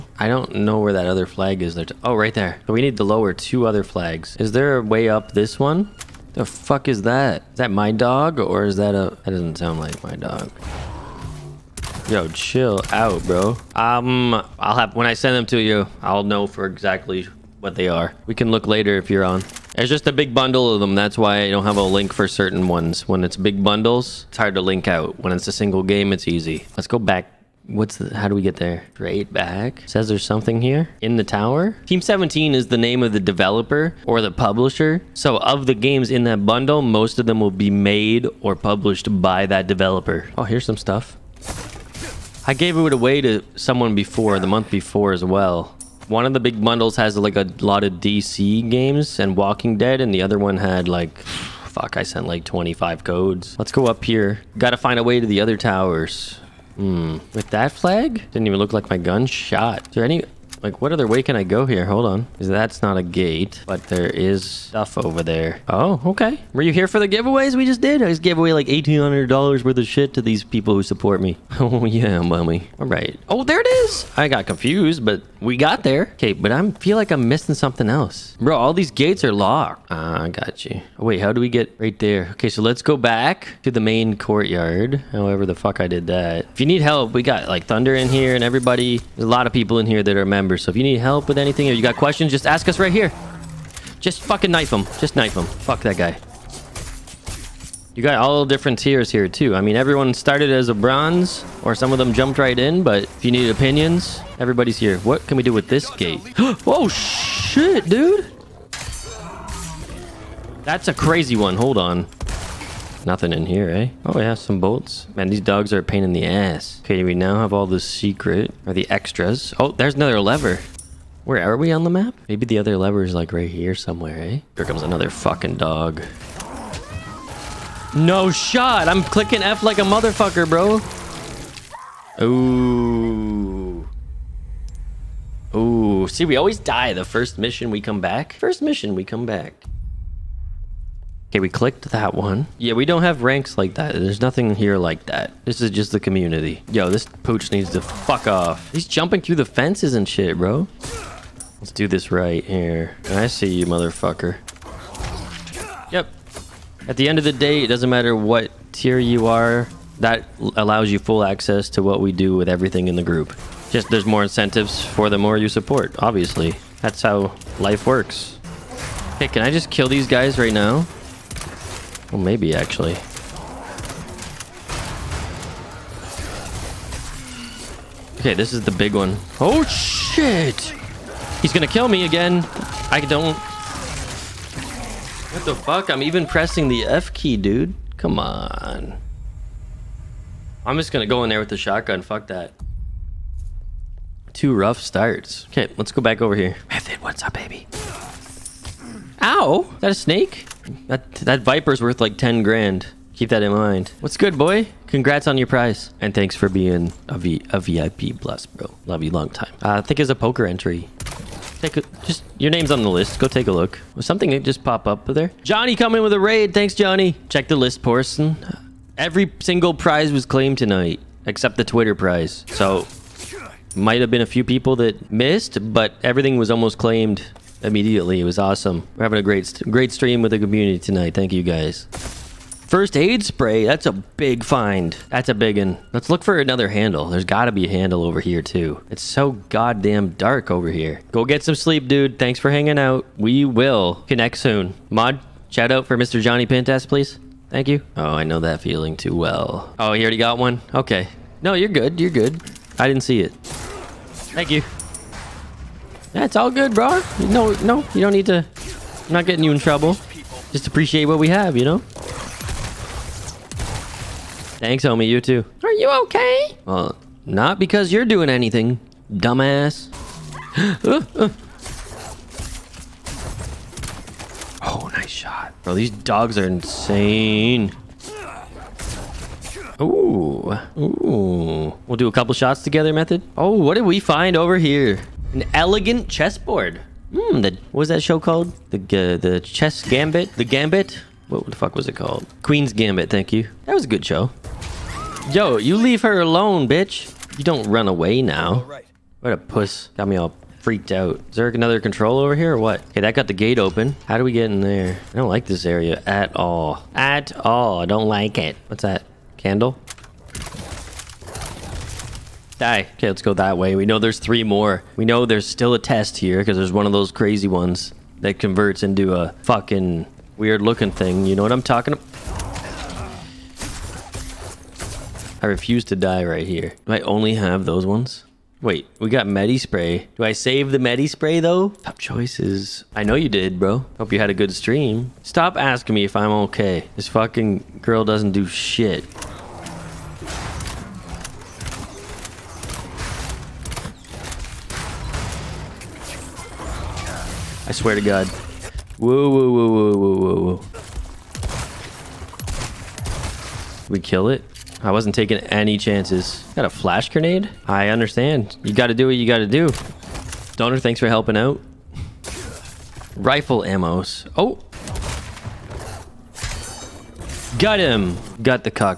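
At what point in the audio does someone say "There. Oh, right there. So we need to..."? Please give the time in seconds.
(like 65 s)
1 s.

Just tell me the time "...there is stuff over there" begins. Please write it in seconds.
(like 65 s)
63 s.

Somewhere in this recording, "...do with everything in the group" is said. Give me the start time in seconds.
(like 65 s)
162 s.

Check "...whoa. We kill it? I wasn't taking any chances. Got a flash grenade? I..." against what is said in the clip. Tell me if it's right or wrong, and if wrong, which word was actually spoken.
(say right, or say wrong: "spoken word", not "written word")
right.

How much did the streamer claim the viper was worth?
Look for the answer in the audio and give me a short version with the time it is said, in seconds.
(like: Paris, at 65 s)
10 grand, at 202 s.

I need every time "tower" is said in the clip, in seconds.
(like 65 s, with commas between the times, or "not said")
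31 s, 55 s.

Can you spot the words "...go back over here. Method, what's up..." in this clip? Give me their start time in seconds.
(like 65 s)
195 s.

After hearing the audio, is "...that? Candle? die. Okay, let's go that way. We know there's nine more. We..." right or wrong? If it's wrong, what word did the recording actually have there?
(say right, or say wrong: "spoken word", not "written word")
wrong: "three", not "nine".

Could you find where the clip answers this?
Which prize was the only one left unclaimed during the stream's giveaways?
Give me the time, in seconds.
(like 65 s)
221 s.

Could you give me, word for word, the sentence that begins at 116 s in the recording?
Okay, we now have all the secret, or the extras.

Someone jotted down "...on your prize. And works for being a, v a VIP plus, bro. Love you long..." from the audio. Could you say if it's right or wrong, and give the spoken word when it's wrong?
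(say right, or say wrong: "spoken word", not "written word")
wrong: "thanks", not "works".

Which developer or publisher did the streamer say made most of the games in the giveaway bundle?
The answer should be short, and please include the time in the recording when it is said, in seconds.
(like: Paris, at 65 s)
Team 17, at 31 s.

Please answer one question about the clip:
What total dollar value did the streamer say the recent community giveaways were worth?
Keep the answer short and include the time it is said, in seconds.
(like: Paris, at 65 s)
$1,800, at 68 s.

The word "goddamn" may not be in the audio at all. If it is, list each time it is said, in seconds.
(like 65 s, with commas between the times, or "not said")
239 s.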